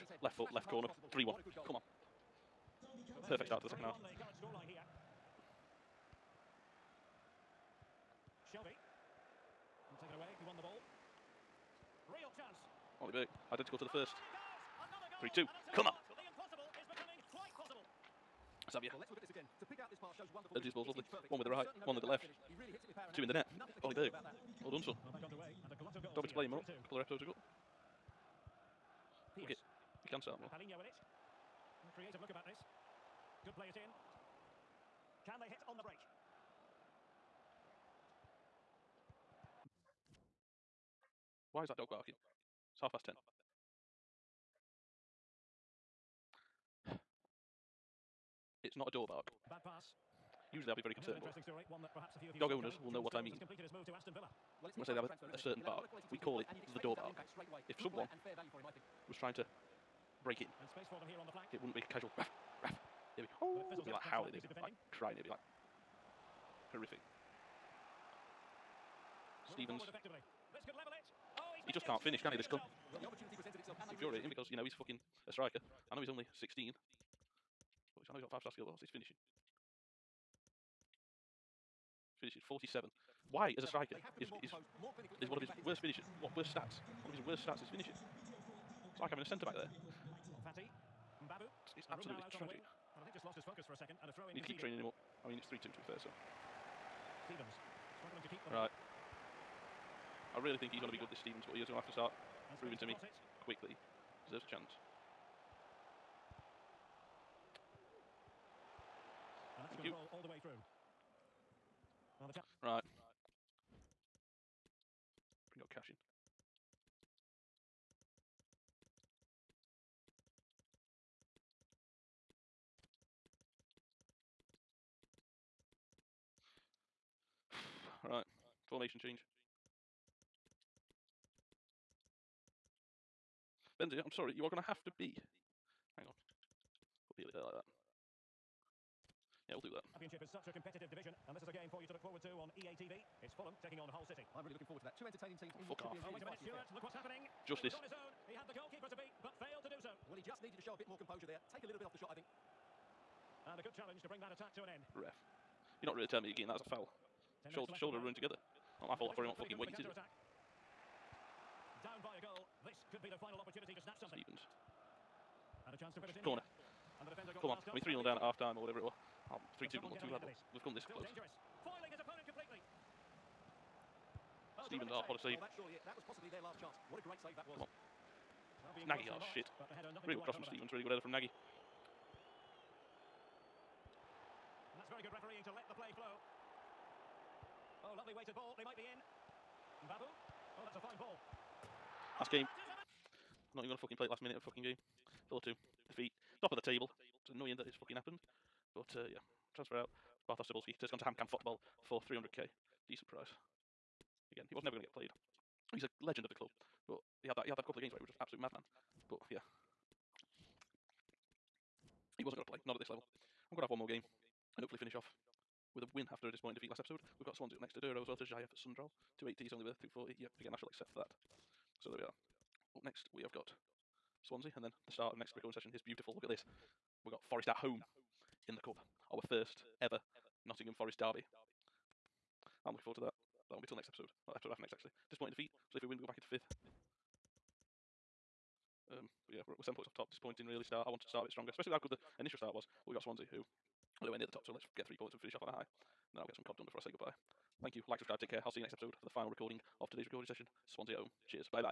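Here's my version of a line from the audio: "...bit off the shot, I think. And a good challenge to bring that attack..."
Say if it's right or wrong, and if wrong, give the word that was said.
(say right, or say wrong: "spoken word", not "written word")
right.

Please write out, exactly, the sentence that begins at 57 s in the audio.
If Good someone him, was trying to break in, it wouldn't be casual, raff, raff, It'd oh.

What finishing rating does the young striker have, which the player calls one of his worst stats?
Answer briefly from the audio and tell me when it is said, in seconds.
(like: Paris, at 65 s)
47, at 82 s.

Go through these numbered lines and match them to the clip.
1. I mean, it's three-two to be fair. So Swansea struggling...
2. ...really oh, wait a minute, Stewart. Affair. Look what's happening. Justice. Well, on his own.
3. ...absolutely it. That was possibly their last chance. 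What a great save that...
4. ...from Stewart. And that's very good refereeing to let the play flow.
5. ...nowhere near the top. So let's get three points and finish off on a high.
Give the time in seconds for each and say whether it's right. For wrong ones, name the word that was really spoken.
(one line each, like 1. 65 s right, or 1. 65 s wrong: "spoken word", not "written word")
1. 95 s wrong: "Stevens", not "Swansea"
2. 146 s right
3. 175 s wrong: "surely", not "absolutely"
4. 181 s wrong: "Nagy", not "Stewart"
5. 244 s right.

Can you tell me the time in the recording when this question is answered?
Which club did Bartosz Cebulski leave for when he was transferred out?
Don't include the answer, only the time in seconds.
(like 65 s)
201 s.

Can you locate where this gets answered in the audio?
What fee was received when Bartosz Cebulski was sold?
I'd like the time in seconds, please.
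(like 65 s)
202 s.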